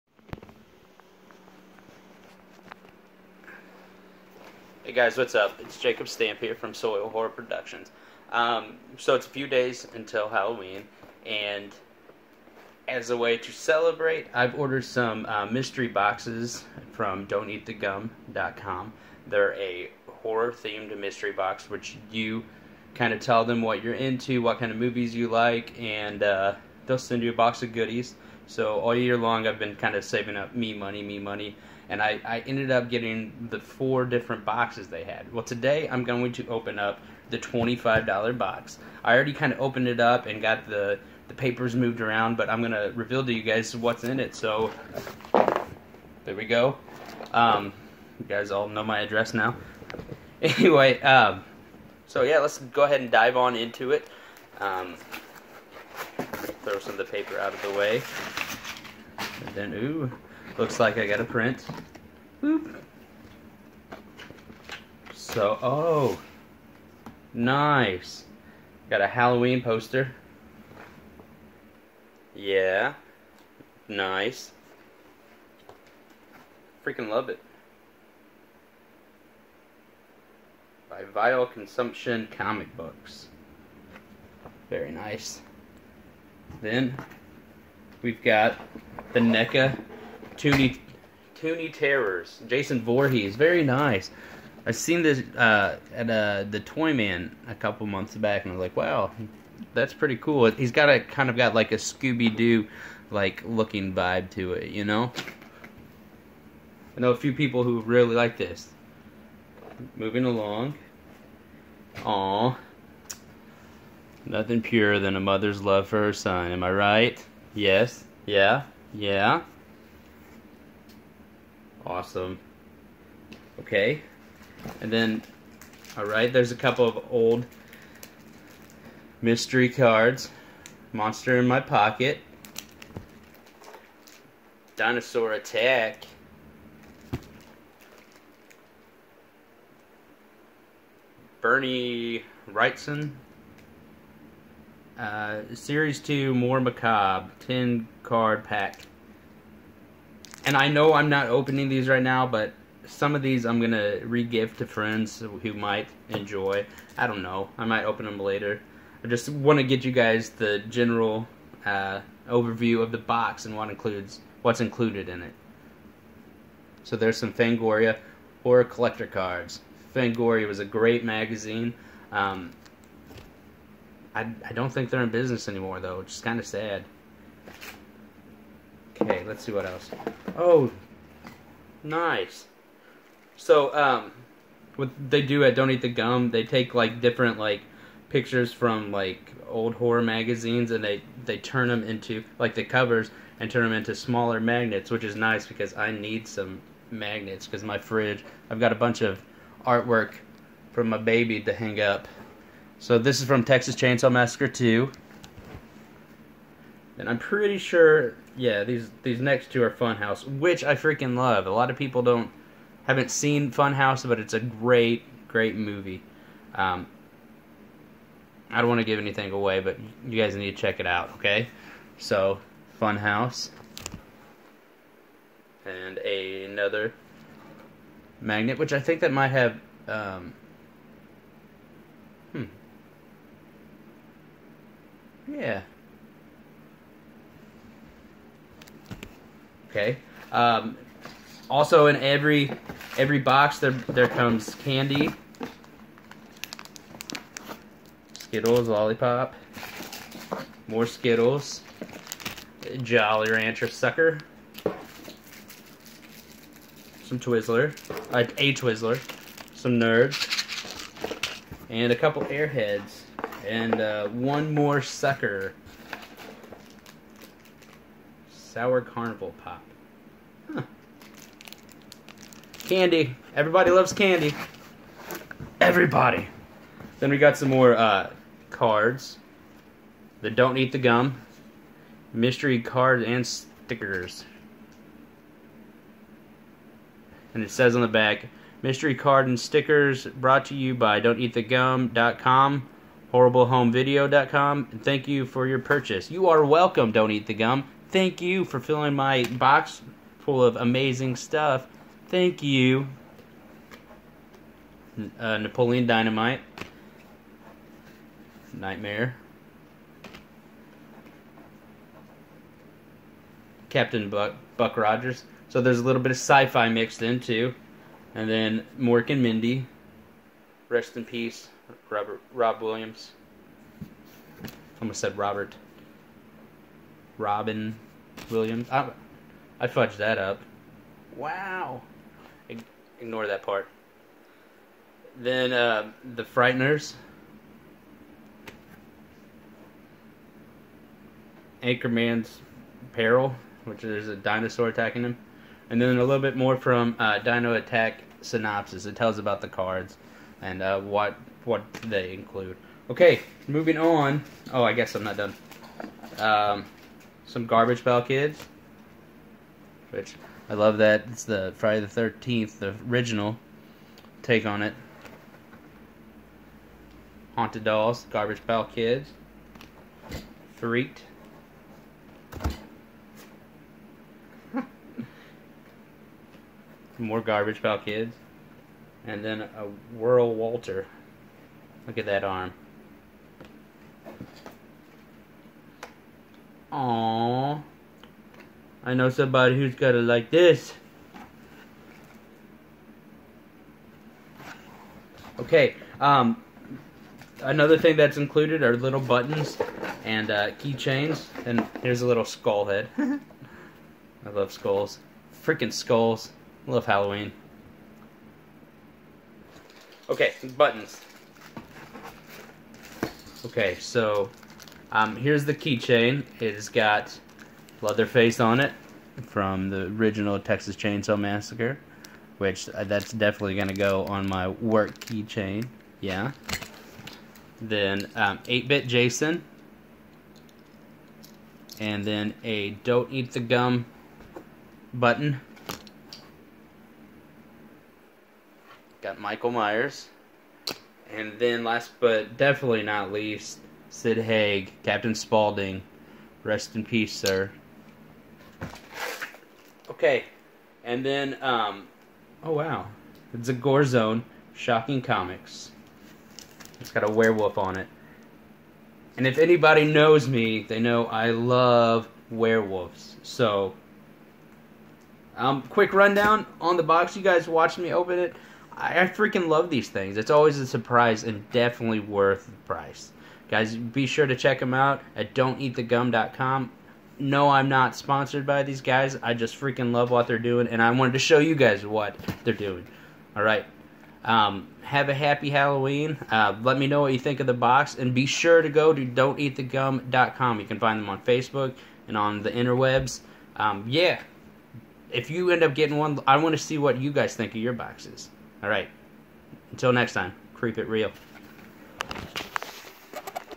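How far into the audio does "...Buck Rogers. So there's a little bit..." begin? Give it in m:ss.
5:14.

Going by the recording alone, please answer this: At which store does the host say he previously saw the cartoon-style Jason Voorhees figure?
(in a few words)
the Toyman.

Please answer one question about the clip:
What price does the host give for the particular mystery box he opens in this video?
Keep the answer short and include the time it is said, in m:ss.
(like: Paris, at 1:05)
$25, at 0:37.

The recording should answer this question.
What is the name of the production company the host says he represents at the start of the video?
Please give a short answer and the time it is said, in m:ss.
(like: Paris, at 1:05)
Soil Horror Productions, at 0:06.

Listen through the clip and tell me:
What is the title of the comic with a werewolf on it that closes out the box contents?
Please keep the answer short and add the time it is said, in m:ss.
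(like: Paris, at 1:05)
Gore Zone Shocking Comics, at 7:33.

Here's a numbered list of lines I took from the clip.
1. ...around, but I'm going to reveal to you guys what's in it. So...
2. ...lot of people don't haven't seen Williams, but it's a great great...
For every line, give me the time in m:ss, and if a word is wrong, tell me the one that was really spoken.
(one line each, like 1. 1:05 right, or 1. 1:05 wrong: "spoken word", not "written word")
1. 0:42 right
2. 3:31 wrong: "Funhouse", not "Williams".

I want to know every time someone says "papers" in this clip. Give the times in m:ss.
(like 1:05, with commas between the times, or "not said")
0:41, 0:57.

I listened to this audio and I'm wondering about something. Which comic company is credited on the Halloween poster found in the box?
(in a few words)
Vital Consumption Comic Books.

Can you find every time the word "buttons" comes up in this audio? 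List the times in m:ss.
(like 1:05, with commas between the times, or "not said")
6:38, 6:50, 7:14.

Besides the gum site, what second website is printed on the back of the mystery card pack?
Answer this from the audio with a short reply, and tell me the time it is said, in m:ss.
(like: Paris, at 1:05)
horriblehomevideo.com, at 4:53.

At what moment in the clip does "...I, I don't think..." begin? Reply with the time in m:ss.
2:54.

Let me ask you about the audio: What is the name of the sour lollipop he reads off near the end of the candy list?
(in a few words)
Sour Carnival Pop.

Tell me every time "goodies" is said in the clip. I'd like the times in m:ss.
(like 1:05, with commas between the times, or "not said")
0:27.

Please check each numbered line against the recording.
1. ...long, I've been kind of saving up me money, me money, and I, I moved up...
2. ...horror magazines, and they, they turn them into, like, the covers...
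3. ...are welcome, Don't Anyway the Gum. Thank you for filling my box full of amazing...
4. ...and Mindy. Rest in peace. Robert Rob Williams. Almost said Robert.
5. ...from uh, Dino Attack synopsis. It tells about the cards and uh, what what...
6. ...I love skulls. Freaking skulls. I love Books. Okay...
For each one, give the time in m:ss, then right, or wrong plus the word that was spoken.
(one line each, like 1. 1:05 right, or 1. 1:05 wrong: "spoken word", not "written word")
1. 0:29 wrong: "ended", not "moved"
2. 3:09 right
3. 4:56 wrong: "Eat", not "Anyway"
4. 5:19 right
5. 5:46 right
6. 6:42 wrong: "Halloween", not "Books".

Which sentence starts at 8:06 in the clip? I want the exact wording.
Uh, let me know what you think of the box, and be sure to go to don'teatthegum.com.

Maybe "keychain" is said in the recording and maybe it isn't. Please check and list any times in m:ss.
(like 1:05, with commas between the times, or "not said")
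6:40, 6:55, 7:05.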